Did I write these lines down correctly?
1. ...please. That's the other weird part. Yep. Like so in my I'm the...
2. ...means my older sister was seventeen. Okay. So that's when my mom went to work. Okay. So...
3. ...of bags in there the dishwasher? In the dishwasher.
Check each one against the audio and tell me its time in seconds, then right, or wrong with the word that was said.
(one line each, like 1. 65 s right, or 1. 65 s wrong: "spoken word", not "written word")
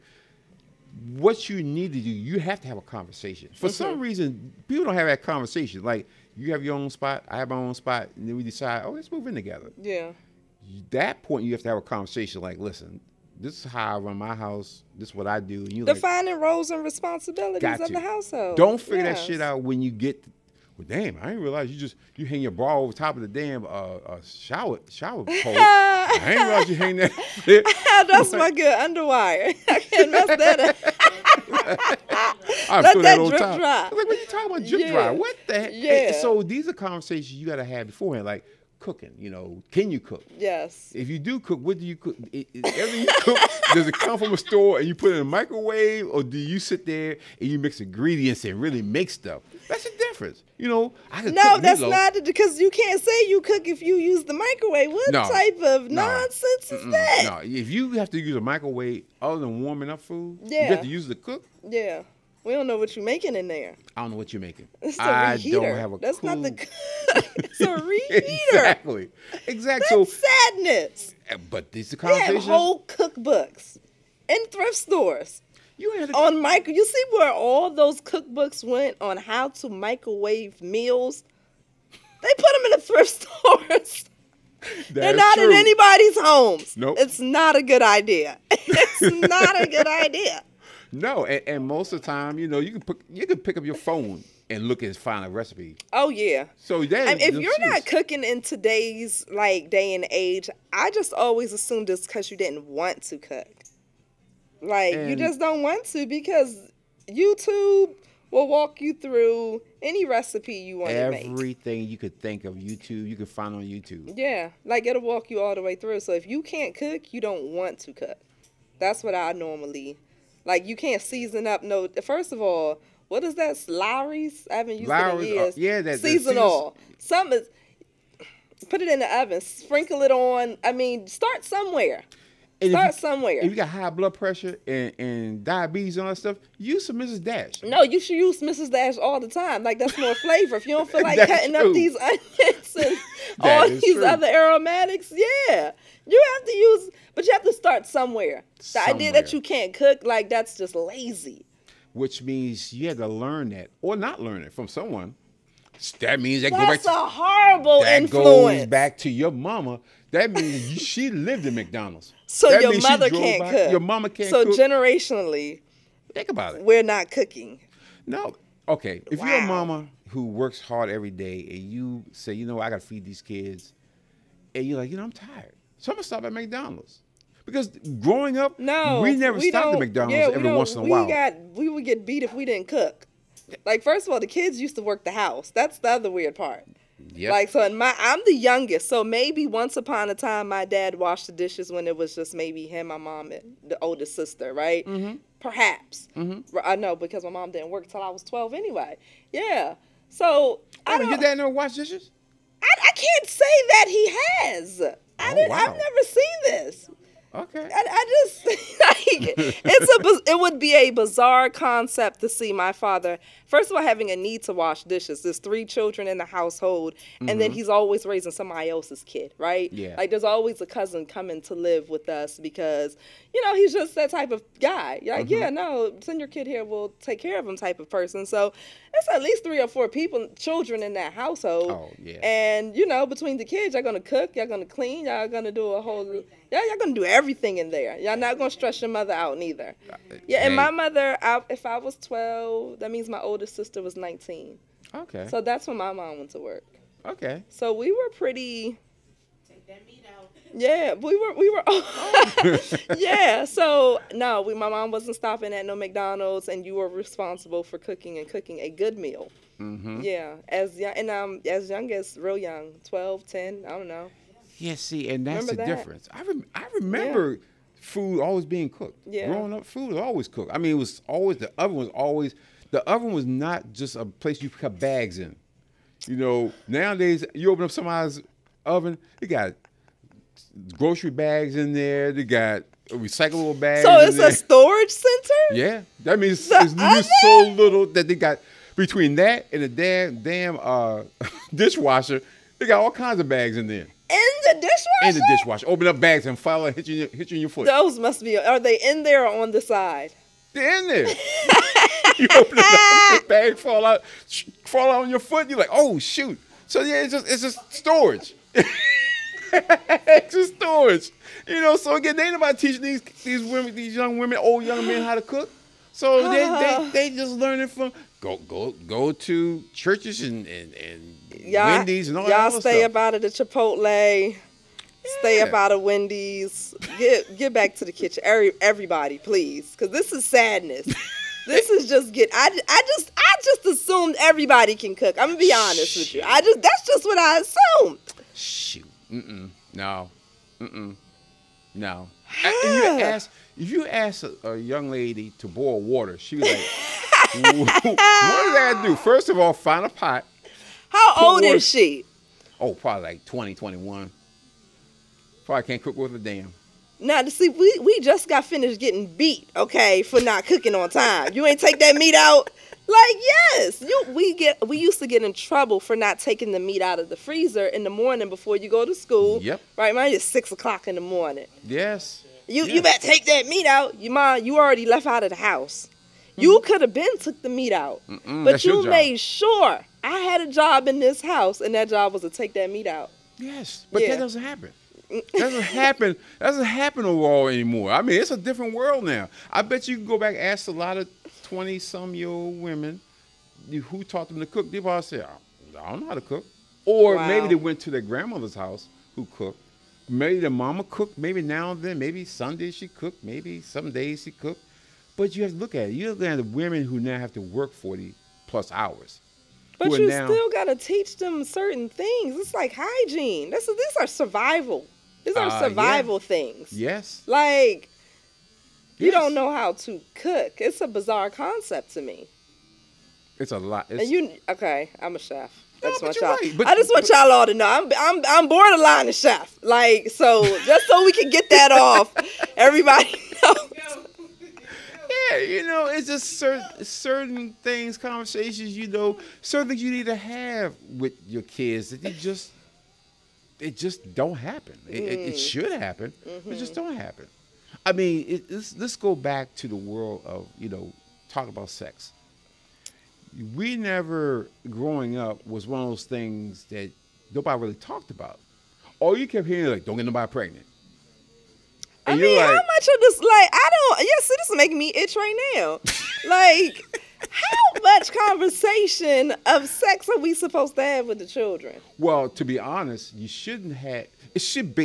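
1. 185 s wrong: "house", not "please"
2. 242 s wrong: "nineteen", not "seventeen"
3. 293 s right.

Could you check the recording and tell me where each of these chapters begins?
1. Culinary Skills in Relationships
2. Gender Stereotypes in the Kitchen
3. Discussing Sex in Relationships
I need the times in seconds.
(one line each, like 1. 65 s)
1. 45 s
2. 315 s
3. 448 s.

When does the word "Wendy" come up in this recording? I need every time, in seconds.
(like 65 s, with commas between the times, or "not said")
321 s, 325 s.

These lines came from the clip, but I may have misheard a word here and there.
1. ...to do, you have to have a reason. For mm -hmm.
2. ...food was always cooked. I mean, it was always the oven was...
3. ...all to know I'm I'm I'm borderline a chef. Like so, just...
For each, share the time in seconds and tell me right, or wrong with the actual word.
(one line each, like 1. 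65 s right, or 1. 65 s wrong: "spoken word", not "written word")
1. 1 s wrong: "conversation", not "reason"
2. 269 s right
3. 427 s right.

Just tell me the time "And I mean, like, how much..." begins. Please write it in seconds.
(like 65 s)
462 s.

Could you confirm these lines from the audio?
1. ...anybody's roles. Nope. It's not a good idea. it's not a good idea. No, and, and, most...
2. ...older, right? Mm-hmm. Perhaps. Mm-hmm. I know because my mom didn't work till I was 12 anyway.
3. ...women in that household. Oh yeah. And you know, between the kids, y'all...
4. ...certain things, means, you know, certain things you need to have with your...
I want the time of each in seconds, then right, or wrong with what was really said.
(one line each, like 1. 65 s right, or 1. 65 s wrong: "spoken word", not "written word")
1. 85 s wrong: "homes", not "roles"
2. 194 s wrong: "sister", not "older"
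3. 230 s wrong: "children", not "women"
4. 436 s wrong: "conversations", not "means".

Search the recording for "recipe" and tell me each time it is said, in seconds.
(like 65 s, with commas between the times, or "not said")
95 s, 110 s.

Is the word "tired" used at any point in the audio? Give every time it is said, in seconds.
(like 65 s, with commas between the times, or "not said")
175 s.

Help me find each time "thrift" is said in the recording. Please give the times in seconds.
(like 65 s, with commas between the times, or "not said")
74 s, 82 s.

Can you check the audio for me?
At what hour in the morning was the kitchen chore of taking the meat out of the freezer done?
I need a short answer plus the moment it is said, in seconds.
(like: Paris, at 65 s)
6 o'clock, at 370 s.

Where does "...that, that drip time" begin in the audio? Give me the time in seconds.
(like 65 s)
32 s.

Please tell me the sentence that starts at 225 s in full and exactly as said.
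yeah, no, send your kid here.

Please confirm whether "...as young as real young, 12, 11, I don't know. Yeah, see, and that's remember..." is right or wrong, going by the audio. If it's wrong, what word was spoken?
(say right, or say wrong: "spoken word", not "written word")
wrong: "10", not "11".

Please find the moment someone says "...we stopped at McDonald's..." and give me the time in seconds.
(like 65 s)
179 s.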